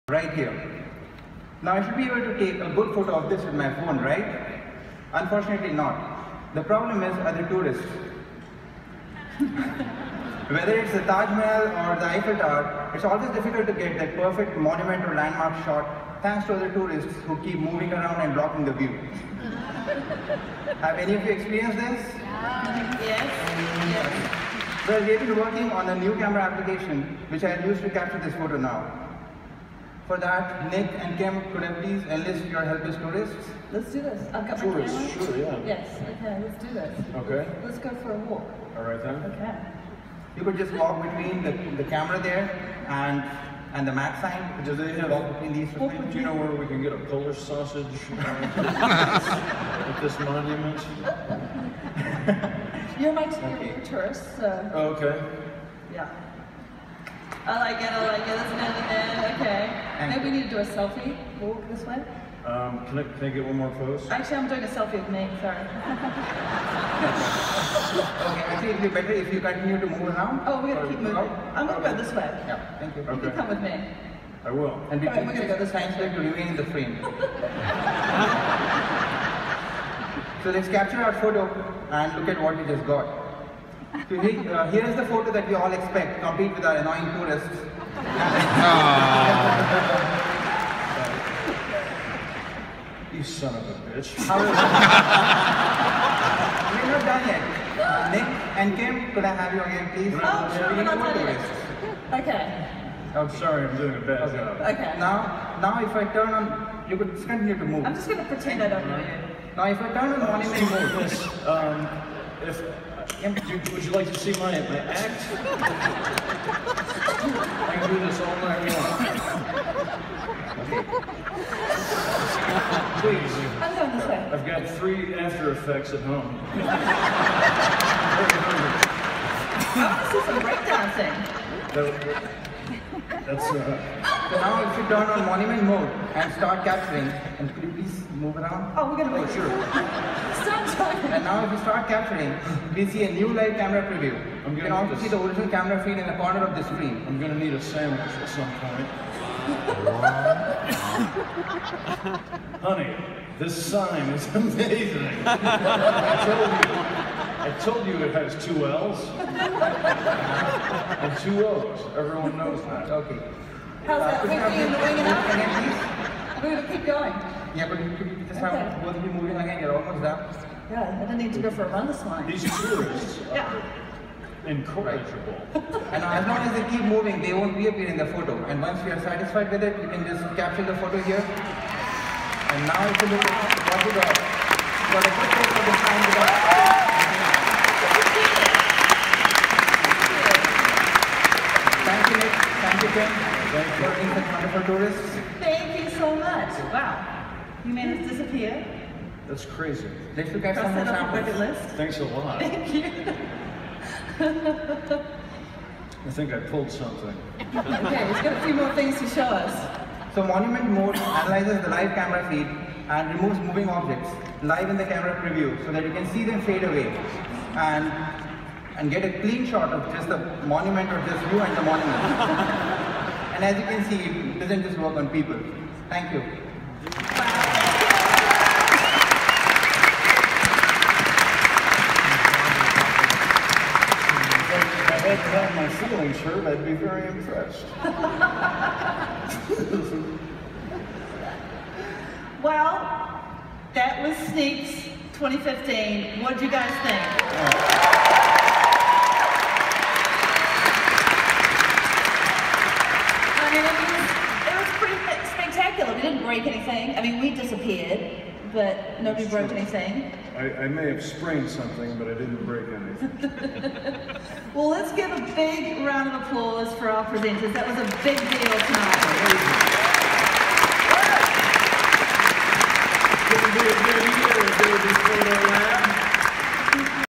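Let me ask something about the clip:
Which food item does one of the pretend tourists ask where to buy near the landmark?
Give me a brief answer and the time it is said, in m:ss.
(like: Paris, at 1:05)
Polish sausage, at 0:47.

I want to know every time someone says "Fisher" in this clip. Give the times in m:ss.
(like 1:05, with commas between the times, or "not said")
not said.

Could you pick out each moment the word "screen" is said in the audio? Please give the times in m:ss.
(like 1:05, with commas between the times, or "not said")
2:26.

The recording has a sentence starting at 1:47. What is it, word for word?
I'm just gonna pretend I don't know you.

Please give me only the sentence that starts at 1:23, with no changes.
Uh, Here's the photo that we all expect, complete with our annoying tourists.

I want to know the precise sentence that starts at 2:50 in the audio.
Yeah, I don't need to go for a run this morning.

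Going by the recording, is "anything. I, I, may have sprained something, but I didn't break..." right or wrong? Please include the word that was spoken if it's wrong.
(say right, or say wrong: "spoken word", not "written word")
right.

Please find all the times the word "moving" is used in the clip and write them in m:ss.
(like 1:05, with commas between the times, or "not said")
0:17, 1:11, 2:49, 2:56, 3:33.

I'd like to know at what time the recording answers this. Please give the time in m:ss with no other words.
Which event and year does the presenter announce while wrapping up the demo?
4:04.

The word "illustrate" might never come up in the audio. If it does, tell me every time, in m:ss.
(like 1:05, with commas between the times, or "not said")
not said.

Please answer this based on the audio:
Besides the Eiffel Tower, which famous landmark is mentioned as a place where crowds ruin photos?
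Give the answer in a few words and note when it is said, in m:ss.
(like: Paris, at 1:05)
Taj Mahal, at 0:11.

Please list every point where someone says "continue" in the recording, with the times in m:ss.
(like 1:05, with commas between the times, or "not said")
1:09, 1:47.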